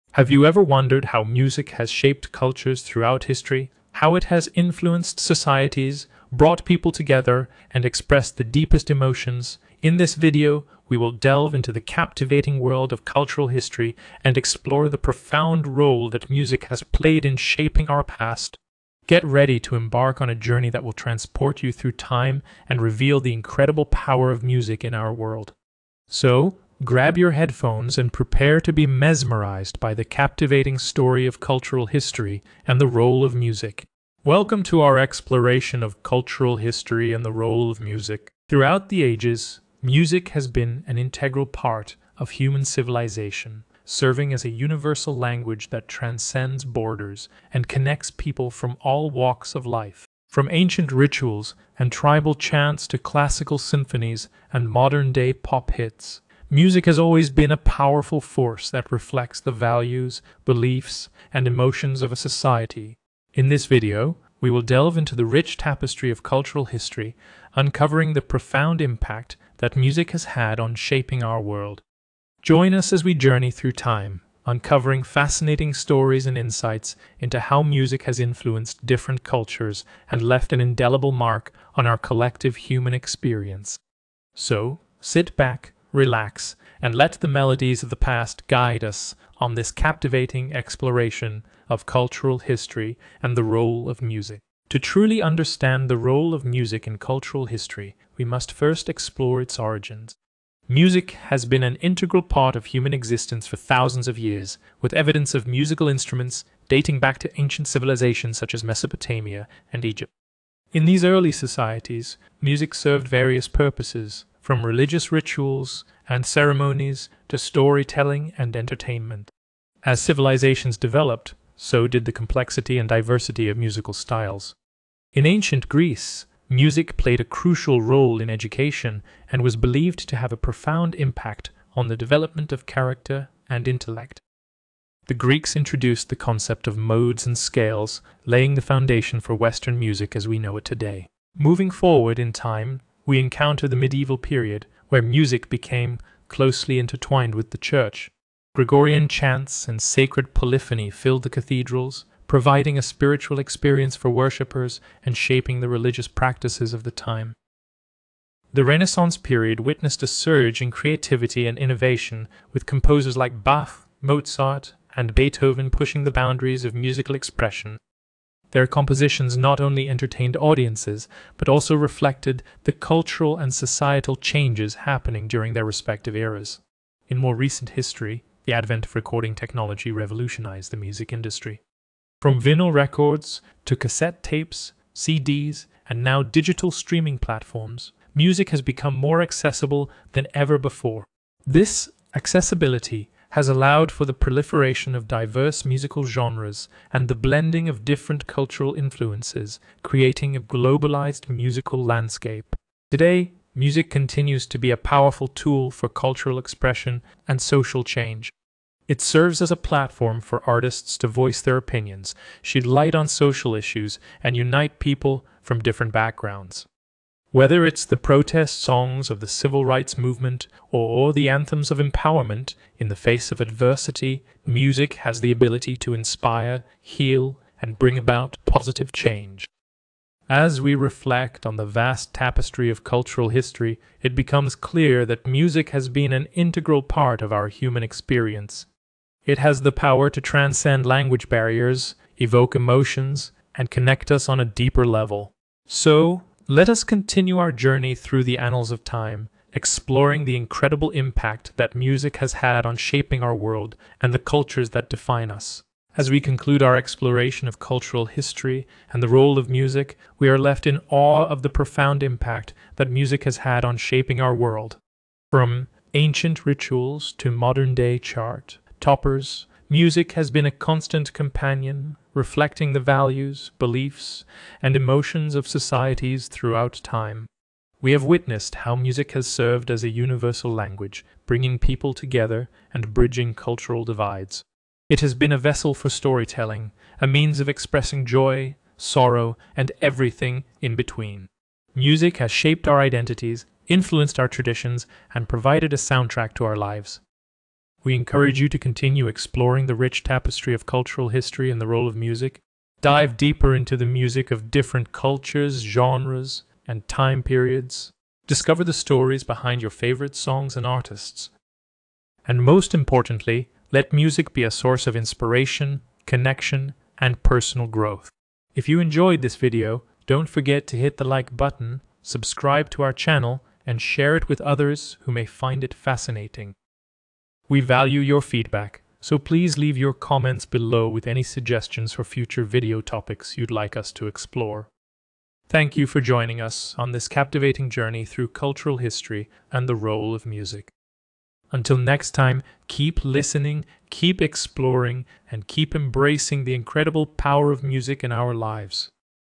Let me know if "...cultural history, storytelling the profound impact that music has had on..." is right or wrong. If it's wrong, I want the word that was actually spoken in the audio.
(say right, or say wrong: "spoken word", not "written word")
wrong: "uncovering", not "storytelling".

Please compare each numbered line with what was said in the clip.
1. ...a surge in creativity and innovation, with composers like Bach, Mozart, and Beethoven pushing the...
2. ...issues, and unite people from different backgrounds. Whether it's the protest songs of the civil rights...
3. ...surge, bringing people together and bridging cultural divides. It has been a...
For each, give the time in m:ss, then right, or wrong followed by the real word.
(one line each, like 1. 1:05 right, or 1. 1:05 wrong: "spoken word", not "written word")
1. 2:40 right
2. 3:33 right
3. 4:40 wrong: "language", not "surge".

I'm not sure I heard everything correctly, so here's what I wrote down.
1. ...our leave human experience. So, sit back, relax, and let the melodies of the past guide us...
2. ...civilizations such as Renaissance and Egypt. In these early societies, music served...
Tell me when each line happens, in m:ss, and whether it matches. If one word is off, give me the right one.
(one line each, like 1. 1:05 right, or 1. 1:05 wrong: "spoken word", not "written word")
1. 1:21 wrong: "collective", not "leave"
2. 1:47 wrong: "Mesopotamia", not "Renaissance".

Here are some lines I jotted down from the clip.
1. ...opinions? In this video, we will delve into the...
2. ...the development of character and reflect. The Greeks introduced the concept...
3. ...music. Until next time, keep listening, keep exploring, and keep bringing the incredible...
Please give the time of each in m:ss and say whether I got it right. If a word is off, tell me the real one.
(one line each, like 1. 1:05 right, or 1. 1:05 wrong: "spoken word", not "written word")
1. 0:08 wrong: "emotions", not "opinions"
2. 2:11 wrong: "intellect", not "reflect"
3. 5:40 wrong: "embracing", not "bringing".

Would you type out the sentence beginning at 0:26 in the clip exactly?
So, Grab your headphones and prepare to be mesmerized by the captivating story of cultural history and the role of music.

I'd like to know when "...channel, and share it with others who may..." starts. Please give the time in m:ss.
5:22.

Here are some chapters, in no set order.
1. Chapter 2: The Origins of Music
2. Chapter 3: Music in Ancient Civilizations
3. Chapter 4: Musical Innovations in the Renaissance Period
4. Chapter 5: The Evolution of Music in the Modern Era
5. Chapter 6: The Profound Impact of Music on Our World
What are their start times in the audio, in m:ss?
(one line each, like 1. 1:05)
1. 1:34
2. 2:20
3. 2:36
4. 2:54
5. 4:12.